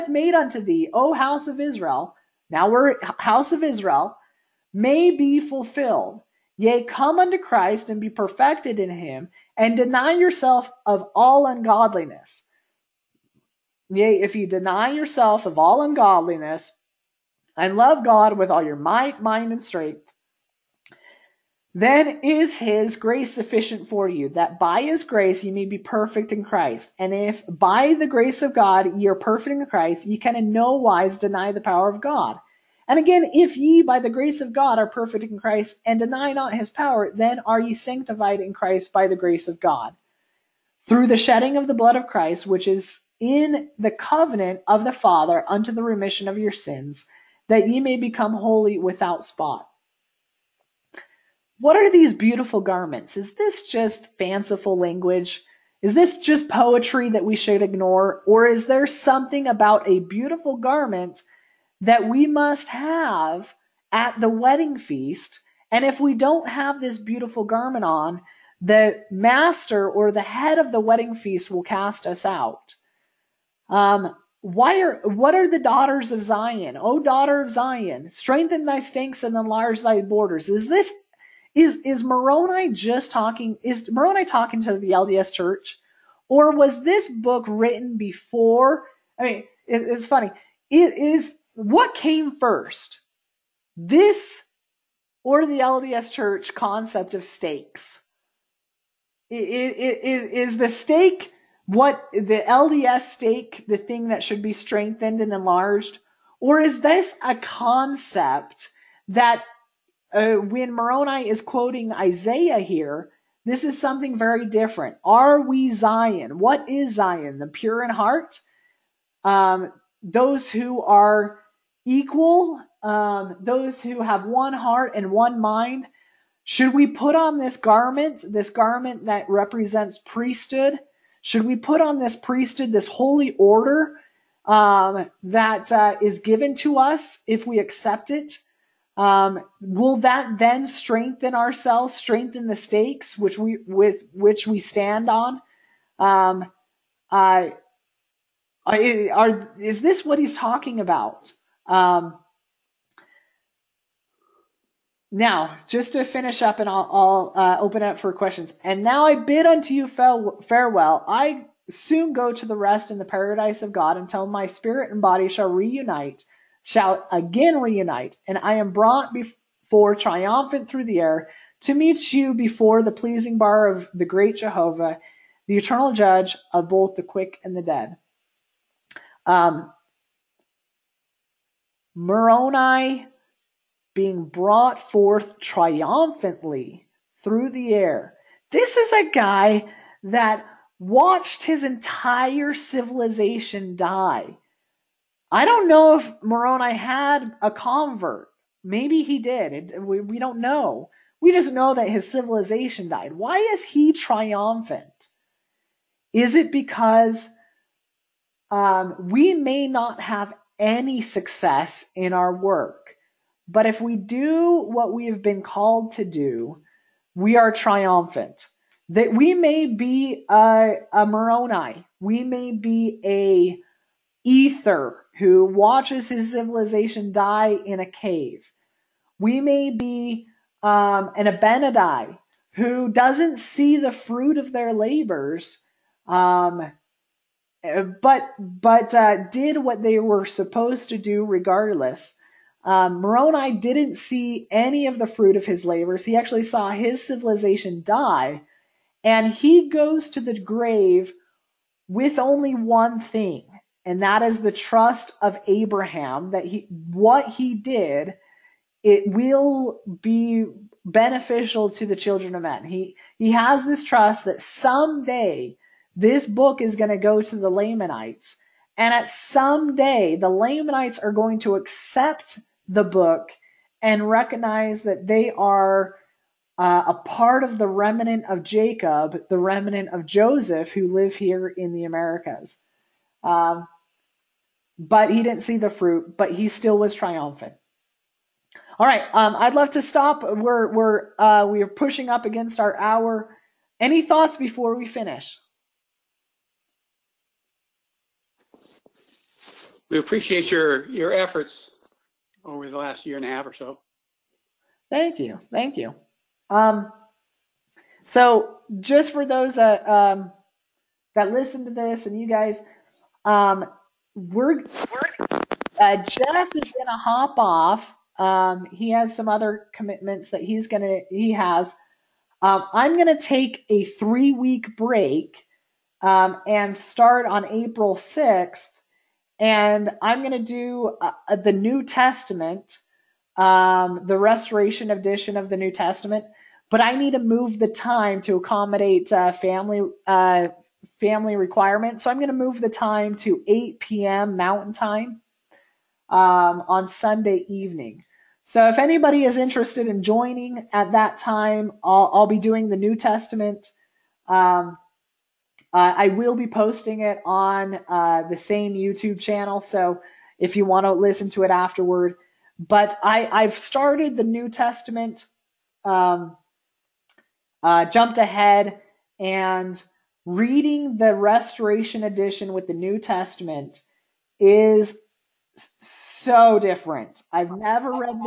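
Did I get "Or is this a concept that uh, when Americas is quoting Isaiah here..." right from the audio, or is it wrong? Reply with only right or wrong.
wrong.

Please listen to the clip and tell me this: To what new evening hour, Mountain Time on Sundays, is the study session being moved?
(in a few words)
8 p.m.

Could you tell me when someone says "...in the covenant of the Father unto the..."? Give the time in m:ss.
0:43.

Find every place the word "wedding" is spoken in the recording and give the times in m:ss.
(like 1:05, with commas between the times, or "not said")
1:04, 1:10.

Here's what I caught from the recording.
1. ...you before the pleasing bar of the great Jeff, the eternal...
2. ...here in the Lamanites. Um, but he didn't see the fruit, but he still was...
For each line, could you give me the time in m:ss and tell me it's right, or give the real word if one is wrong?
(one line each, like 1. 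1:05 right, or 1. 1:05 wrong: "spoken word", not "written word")
1. 2:52 wrong: "Jehovah", not "Jeff"
2. 4:41 wrong: "Americas", not "Lamanites".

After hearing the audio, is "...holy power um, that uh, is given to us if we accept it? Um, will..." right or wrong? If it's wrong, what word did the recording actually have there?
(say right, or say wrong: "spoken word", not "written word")
wrong: "order", not "power".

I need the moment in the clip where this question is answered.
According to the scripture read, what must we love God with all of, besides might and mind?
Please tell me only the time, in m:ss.
0:19.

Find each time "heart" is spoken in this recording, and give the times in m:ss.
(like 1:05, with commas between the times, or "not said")
1:57, 2:04.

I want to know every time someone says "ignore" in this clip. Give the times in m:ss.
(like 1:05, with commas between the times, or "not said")
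0:57.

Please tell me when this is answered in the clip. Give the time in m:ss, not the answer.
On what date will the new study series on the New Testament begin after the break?
5:27.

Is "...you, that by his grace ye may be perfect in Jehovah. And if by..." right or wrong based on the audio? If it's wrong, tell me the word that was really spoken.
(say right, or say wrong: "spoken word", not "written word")
wrong: "Christ", not "Jehovah".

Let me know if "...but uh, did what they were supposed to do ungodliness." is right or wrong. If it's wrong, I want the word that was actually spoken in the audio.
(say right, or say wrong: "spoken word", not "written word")
wrong: "regardless", not "ungodliness".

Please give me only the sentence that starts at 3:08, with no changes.
This is a guy that watched his entire civilization die.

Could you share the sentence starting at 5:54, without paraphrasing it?
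Um, uh, I will be posting it on uh, the same YouTube channel, so if you want to listen to it afterward.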